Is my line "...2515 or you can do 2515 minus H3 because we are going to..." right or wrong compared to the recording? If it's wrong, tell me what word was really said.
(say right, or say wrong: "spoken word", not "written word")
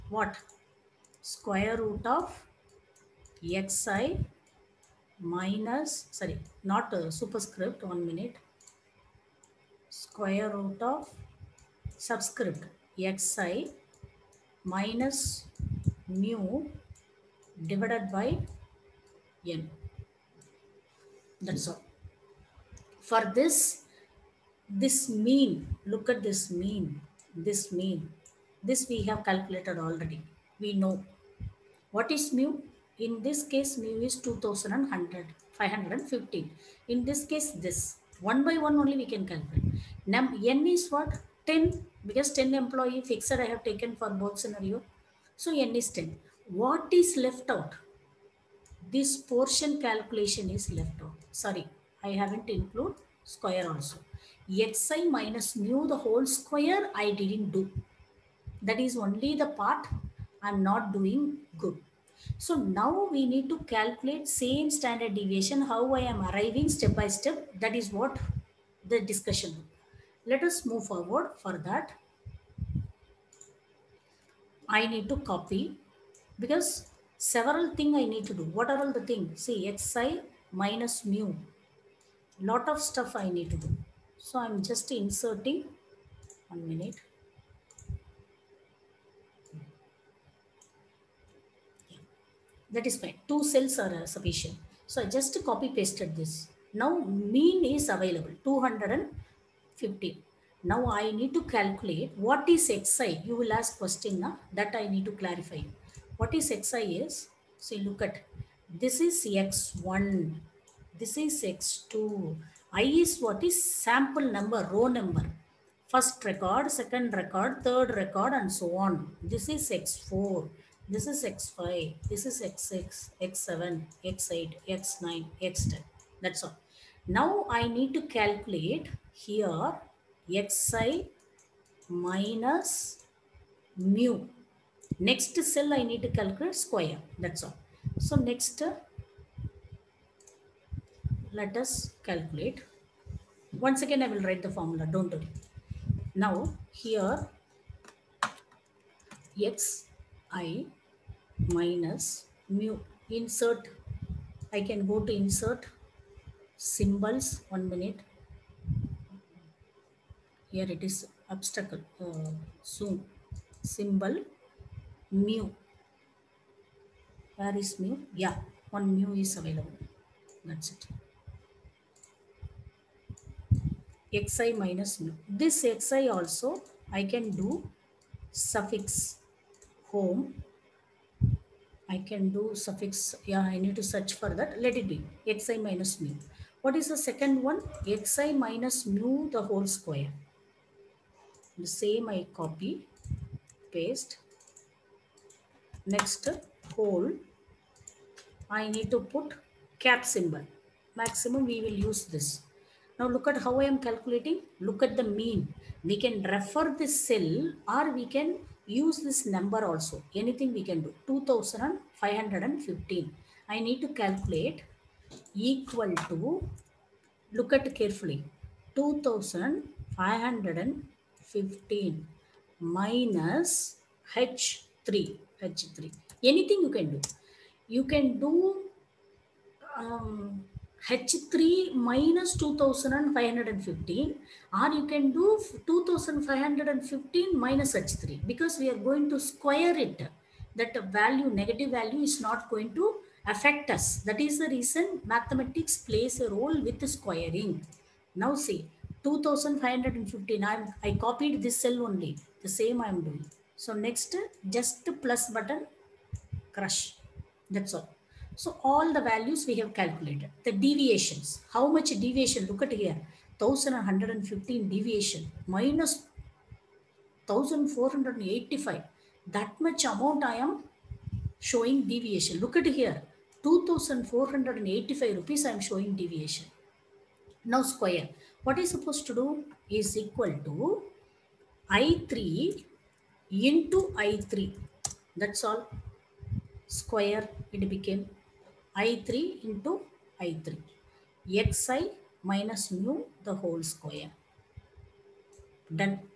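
right.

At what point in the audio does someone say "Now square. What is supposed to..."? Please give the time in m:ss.
4:37.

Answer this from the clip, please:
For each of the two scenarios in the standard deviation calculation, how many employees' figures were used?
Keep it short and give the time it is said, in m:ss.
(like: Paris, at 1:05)
10, at 0:42.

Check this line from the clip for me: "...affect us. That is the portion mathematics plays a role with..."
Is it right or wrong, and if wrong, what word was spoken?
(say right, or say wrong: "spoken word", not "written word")
wrong: "reason", not "portion".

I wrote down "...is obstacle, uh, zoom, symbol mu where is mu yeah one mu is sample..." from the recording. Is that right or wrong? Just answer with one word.
wrong.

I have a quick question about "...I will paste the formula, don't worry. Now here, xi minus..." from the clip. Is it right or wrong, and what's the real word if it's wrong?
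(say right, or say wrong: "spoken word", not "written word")
wrong: "write", not "paste".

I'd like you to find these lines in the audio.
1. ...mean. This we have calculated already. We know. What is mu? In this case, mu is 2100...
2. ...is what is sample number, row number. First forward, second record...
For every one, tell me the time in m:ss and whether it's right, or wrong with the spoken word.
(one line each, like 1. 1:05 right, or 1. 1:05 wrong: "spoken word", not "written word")
1. 0:27 right
2. 1:52 wrong: "record", not "forward".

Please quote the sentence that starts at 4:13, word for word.
So next, just plus button, crush.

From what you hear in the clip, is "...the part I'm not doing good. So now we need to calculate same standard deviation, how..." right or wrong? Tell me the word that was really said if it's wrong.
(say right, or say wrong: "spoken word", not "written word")
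right.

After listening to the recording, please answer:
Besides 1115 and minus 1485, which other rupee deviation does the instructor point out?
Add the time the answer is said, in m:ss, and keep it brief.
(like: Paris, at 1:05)
2485, at 4:33.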